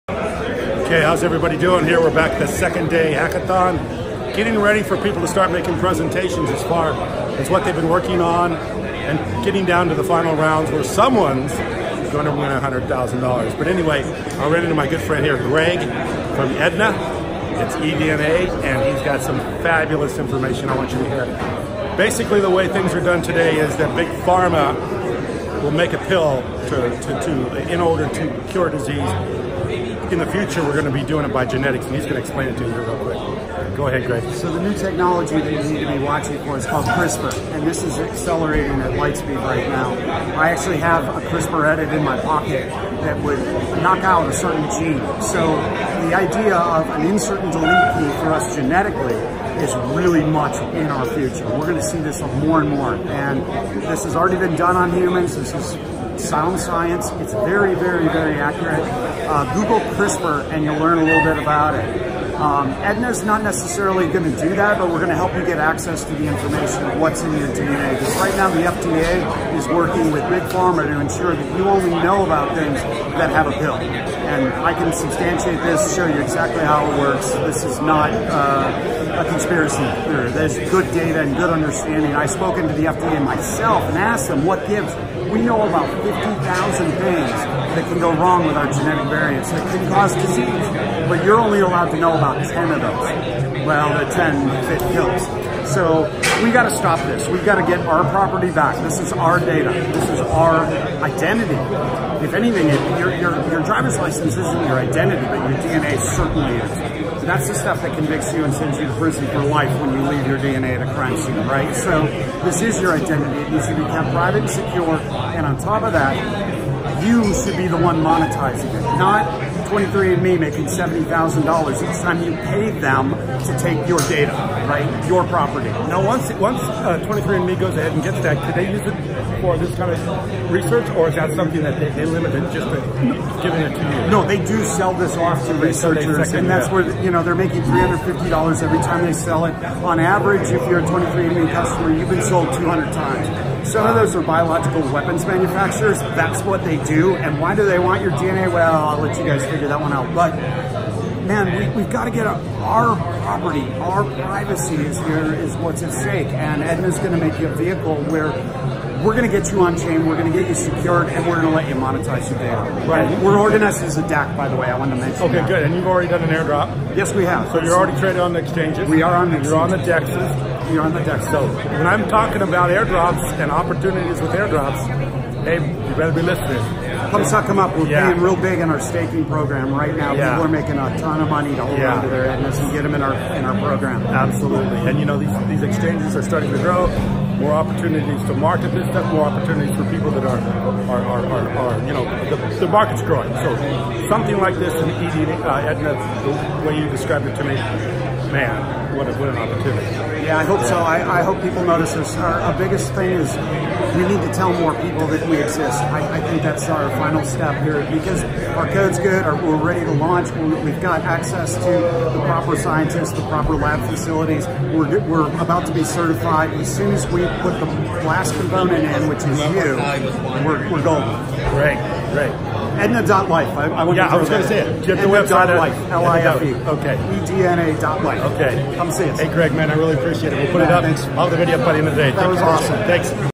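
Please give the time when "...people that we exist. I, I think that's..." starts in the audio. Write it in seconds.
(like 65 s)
204 s.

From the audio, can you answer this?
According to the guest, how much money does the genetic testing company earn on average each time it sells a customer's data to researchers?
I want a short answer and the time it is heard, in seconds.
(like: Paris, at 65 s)
$350, at 137 s.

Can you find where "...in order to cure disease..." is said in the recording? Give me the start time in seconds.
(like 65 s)
27 s.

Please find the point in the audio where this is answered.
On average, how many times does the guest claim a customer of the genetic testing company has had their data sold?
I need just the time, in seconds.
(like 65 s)
142 s.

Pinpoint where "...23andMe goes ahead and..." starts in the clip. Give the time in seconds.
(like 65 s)
127 s.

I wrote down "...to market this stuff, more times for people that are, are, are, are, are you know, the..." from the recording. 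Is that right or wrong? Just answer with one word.
wrong.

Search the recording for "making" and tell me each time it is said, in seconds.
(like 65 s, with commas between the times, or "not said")
5 s, 120 s, 137 s, 180 s.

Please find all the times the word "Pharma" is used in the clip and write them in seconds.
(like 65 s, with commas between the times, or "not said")
24 s, 70 s.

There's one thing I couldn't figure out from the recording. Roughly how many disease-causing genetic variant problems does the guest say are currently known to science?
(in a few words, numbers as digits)
50,000.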